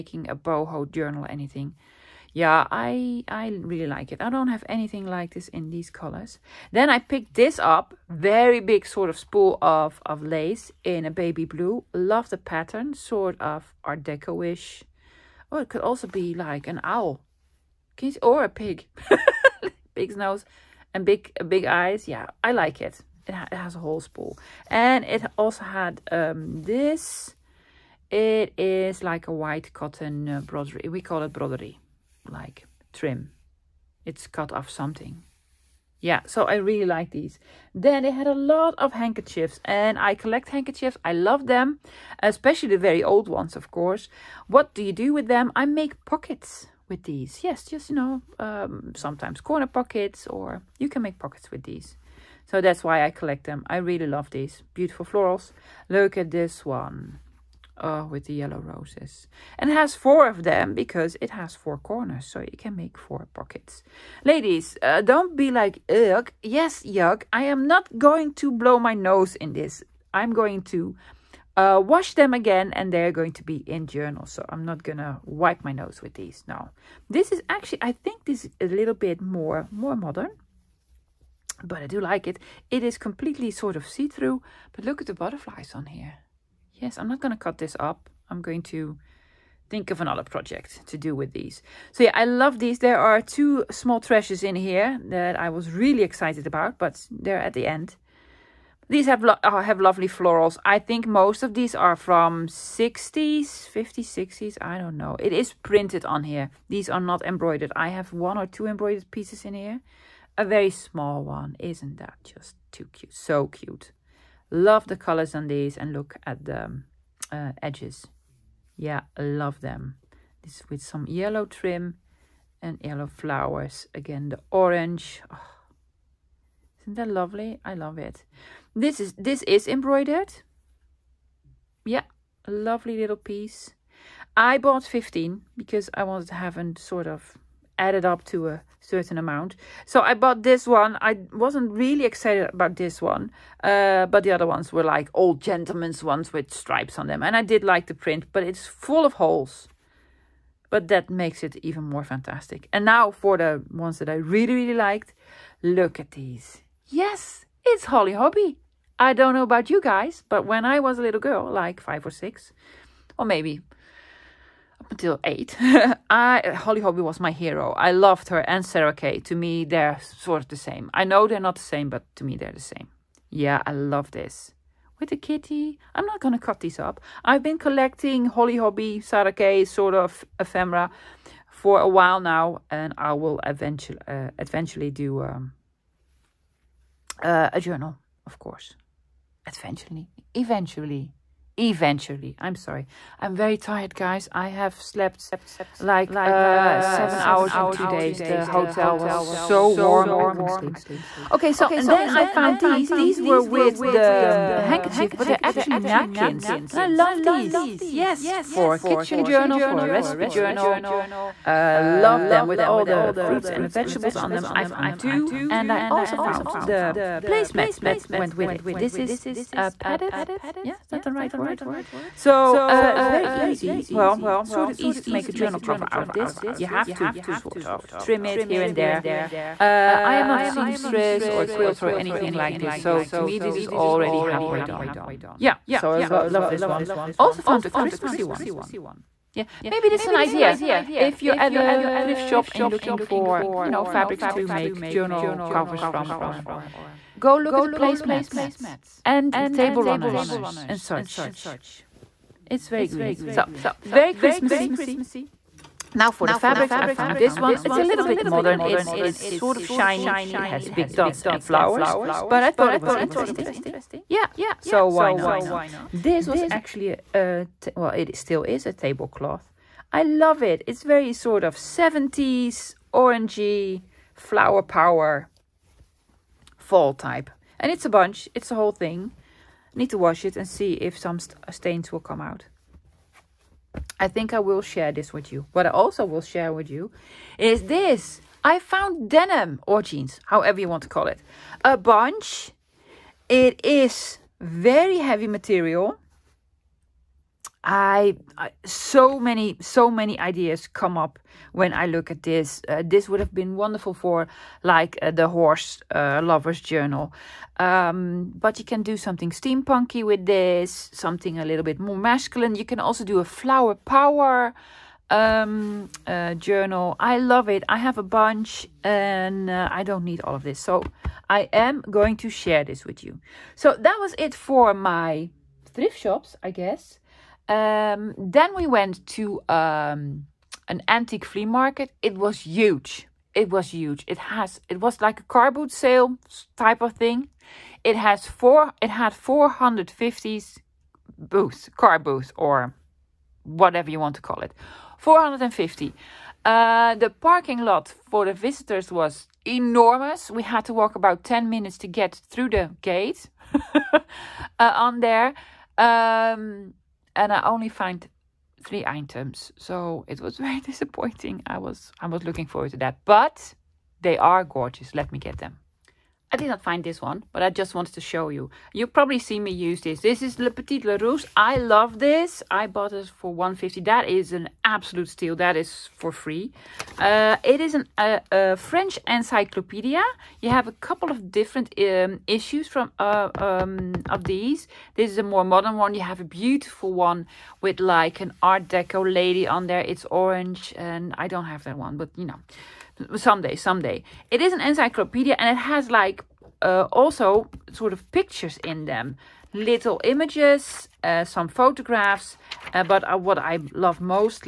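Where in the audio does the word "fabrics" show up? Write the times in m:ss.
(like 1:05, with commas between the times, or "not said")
4:03, 4:16.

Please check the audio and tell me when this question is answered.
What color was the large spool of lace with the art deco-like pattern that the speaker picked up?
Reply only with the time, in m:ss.
0:11.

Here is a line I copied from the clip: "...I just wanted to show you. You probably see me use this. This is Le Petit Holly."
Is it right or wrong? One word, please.
wrong.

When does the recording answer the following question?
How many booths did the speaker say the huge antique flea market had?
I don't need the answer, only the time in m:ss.
5:39.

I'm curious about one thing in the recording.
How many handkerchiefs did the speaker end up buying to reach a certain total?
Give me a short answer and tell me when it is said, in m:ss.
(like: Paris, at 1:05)
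15, at 2:14.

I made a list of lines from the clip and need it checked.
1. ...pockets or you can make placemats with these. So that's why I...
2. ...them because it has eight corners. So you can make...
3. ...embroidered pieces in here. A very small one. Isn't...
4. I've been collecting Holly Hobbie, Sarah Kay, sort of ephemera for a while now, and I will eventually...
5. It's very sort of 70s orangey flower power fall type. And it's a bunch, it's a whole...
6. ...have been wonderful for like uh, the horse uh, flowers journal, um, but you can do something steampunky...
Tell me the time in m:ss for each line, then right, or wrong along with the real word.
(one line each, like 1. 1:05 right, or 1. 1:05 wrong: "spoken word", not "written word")
1. 0:49 wrong: "pockets", not "placemats"
2. 1:00 wrong: "four", not "eight"
3. 1:48 right
4. 2:57 right
5. 4:30 right
6. 5:03 wrong: "lovers", not "flowers".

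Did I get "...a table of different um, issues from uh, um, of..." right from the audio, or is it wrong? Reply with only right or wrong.
wrong.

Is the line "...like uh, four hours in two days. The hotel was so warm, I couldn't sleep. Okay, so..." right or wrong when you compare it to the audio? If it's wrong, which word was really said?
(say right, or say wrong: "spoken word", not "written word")
wrong: "seven", not "four".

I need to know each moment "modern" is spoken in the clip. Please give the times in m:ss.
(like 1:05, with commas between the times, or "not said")
1:19, 4:18, 6:25.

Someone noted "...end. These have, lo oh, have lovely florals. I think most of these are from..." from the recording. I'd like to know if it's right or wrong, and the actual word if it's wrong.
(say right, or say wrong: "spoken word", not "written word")
right.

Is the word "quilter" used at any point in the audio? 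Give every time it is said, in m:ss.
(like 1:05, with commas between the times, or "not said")
3:51.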